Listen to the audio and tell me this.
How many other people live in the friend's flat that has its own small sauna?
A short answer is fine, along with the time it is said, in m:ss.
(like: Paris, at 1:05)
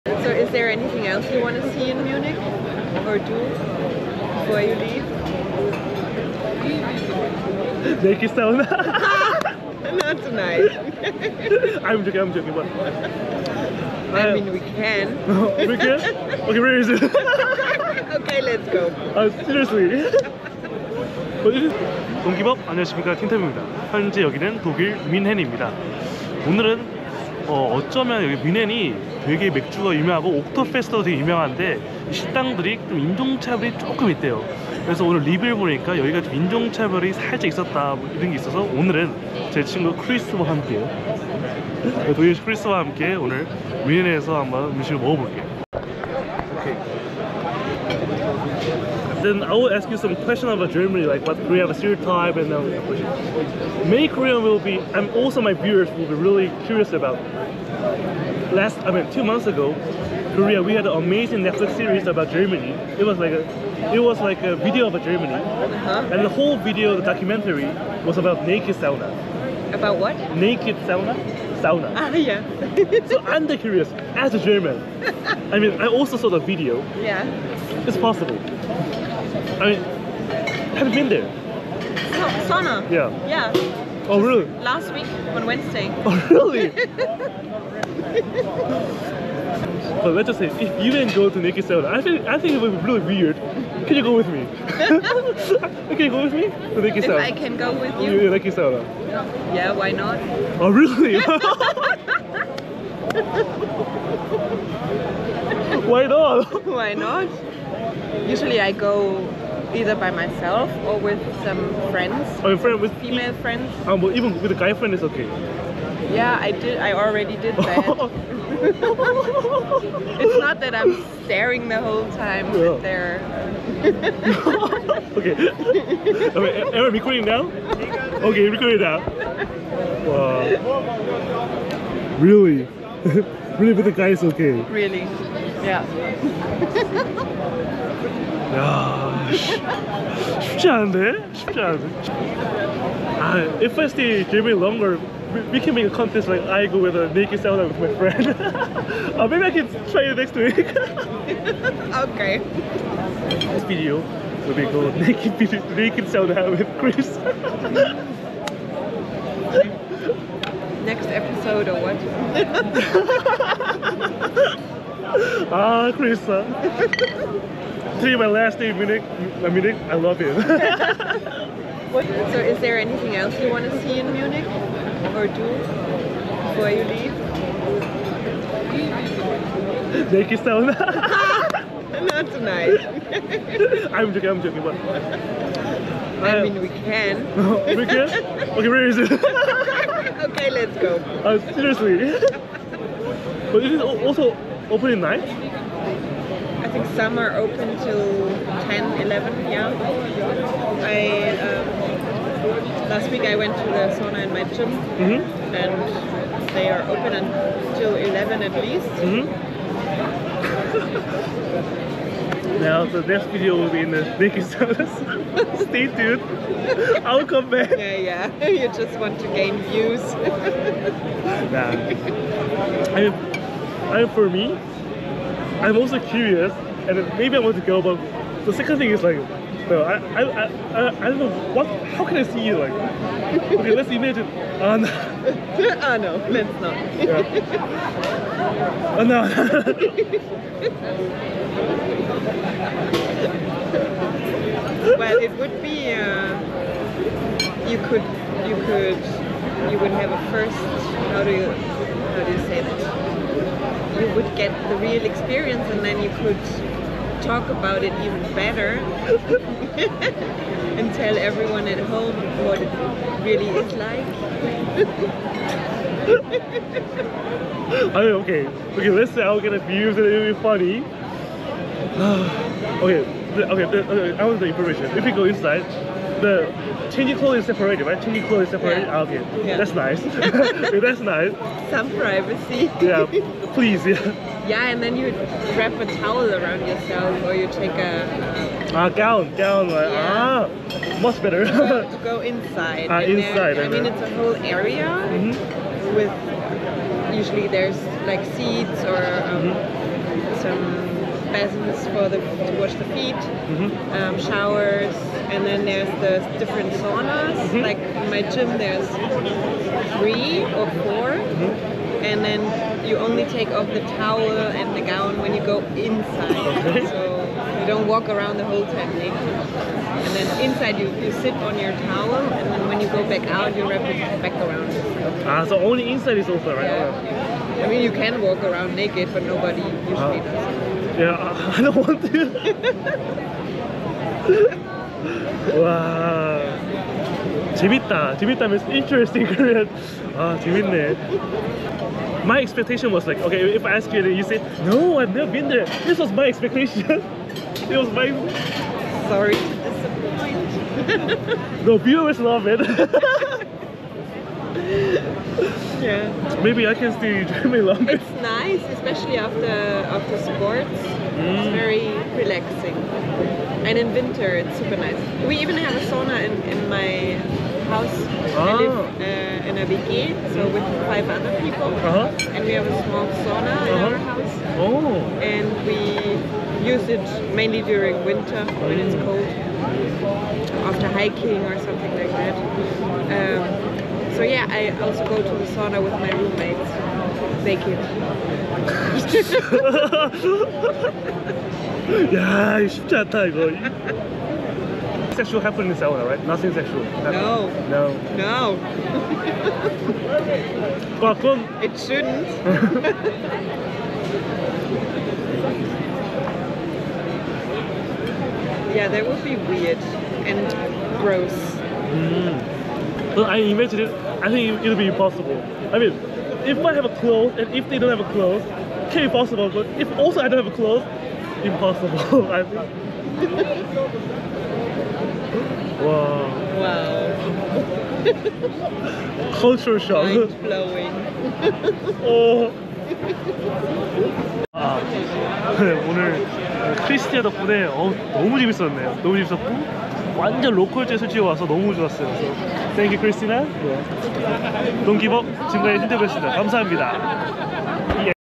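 5, at 6:10.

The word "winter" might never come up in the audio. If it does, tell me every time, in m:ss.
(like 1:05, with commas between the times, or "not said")
6:03, 6:18.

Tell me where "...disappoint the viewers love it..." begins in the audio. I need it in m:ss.
5:50.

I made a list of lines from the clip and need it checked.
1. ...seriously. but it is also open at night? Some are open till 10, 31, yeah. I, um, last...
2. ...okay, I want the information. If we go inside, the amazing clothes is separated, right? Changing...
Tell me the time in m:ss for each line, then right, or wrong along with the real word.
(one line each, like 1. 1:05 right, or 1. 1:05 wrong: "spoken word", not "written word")
1. 3:11 wrong: "11", not "31"
2. 4:33 wrong: "changing", not "amazing".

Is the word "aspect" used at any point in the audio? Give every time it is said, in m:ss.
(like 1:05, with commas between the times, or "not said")
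not said.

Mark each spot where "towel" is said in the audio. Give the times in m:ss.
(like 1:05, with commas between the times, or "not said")
4:45, 5:13, 5:21.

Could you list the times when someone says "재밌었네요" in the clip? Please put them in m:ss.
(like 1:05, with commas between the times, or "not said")
7:18.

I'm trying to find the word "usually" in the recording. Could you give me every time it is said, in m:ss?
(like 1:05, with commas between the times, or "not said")
1:48, 4:57, 5:29.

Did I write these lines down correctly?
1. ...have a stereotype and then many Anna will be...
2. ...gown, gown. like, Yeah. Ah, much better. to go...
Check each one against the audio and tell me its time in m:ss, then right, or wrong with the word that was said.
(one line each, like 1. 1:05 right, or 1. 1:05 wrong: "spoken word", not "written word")
1. 0:51 wrong: "Korean", not "Anna"
2. 4:48 right.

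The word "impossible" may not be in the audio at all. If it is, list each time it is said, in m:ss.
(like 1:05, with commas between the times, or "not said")
6:54, 7:01.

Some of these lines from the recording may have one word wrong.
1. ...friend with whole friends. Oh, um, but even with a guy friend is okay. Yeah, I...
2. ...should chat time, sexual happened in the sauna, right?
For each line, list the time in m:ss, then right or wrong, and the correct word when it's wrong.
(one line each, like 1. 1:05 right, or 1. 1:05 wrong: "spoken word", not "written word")
1. 1:52 wrong: "female", not "whole"
2. 6:32 right.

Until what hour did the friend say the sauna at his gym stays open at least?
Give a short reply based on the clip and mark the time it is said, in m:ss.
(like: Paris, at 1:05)
11, at 3:27.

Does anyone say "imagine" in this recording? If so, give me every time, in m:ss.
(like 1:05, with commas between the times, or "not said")
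3:53, 6:53.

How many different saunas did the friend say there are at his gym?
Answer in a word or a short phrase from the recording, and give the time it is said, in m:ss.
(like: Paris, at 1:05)
3 or 4, at 5:09.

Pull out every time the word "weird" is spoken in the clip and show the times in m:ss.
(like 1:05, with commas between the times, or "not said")
1:33, 6:49.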